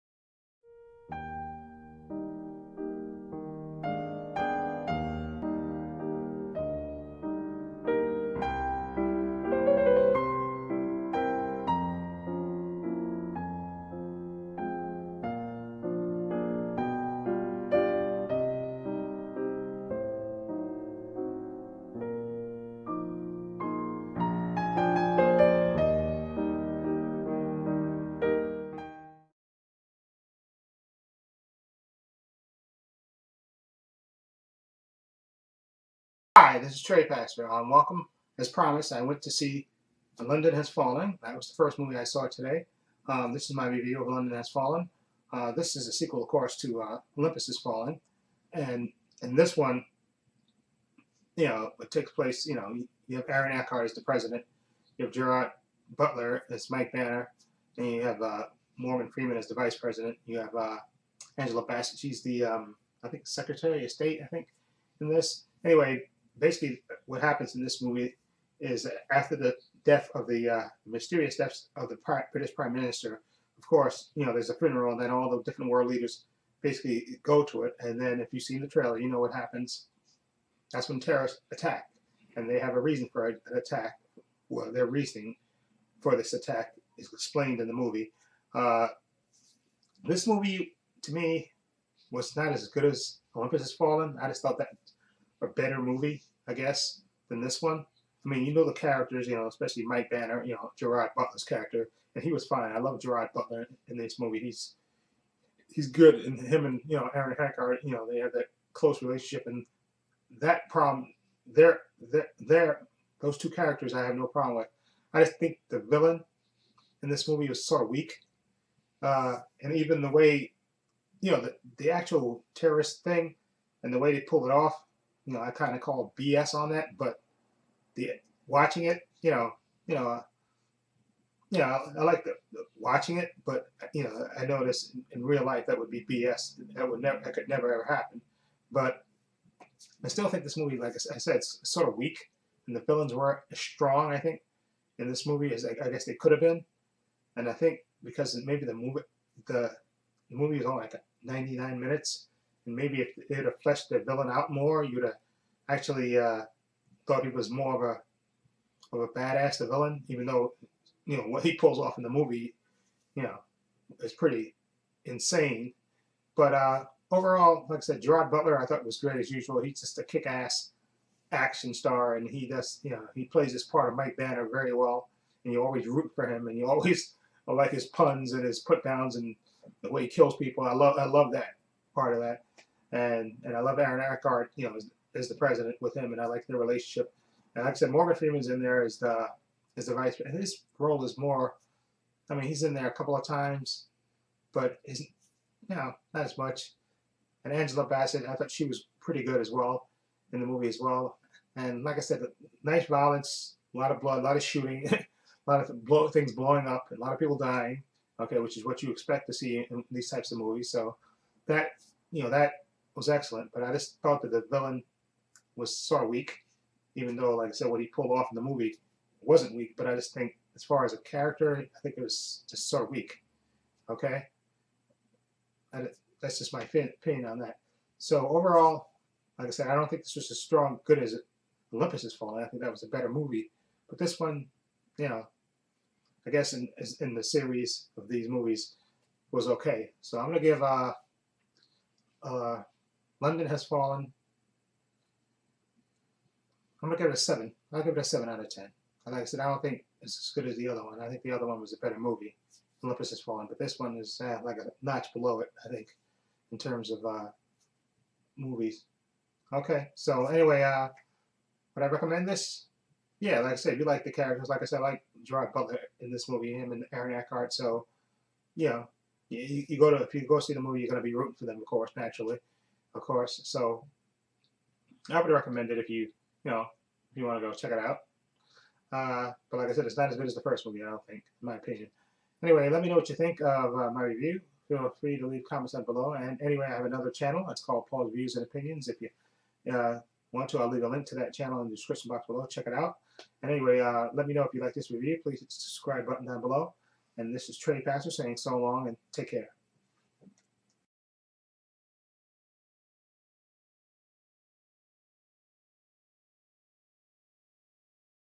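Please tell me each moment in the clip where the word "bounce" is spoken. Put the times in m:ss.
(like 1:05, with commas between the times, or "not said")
not said.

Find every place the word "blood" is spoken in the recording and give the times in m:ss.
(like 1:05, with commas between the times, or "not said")
3:23.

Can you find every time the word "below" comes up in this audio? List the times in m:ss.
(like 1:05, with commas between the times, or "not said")
4:15, 4:45, 4:52, 4:56.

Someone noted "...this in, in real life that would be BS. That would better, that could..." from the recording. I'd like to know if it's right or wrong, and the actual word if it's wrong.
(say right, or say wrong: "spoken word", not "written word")
wrong: "never", not "better".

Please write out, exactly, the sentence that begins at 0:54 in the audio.
You have Gerard Butler as Mike Banning.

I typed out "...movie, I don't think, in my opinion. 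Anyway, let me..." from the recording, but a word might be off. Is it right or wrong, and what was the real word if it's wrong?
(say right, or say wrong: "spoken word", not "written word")
right.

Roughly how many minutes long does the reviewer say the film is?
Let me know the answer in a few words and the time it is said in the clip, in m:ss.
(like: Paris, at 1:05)
99, at 2:31.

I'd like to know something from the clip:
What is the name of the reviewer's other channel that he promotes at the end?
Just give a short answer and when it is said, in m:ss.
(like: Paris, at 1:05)
Paul's Views and Opinions, at 4:47.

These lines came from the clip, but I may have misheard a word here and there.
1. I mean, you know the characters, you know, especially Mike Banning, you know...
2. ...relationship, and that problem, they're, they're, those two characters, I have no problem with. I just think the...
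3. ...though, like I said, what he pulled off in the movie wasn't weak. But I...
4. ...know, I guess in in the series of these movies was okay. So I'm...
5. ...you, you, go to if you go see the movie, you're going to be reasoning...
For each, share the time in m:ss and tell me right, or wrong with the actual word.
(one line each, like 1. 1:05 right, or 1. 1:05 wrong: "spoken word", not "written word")
1. 1:38 right
2. 1:49 right
3. 3:37 right
4. 3:55 right
5. 4:29 wrong: "rooting", not "reasoning".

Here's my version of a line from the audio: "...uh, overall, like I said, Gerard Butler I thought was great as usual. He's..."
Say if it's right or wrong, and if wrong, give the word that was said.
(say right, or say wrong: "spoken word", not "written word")
right.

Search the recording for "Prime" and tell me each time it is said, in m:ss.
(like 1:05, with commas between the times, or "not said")
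1:12.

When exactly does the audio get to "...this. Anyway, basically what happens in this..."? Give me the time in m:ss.
1:05.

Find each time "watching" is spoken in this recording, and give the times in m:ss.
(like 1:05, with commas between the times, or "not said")
2:08, 2:12.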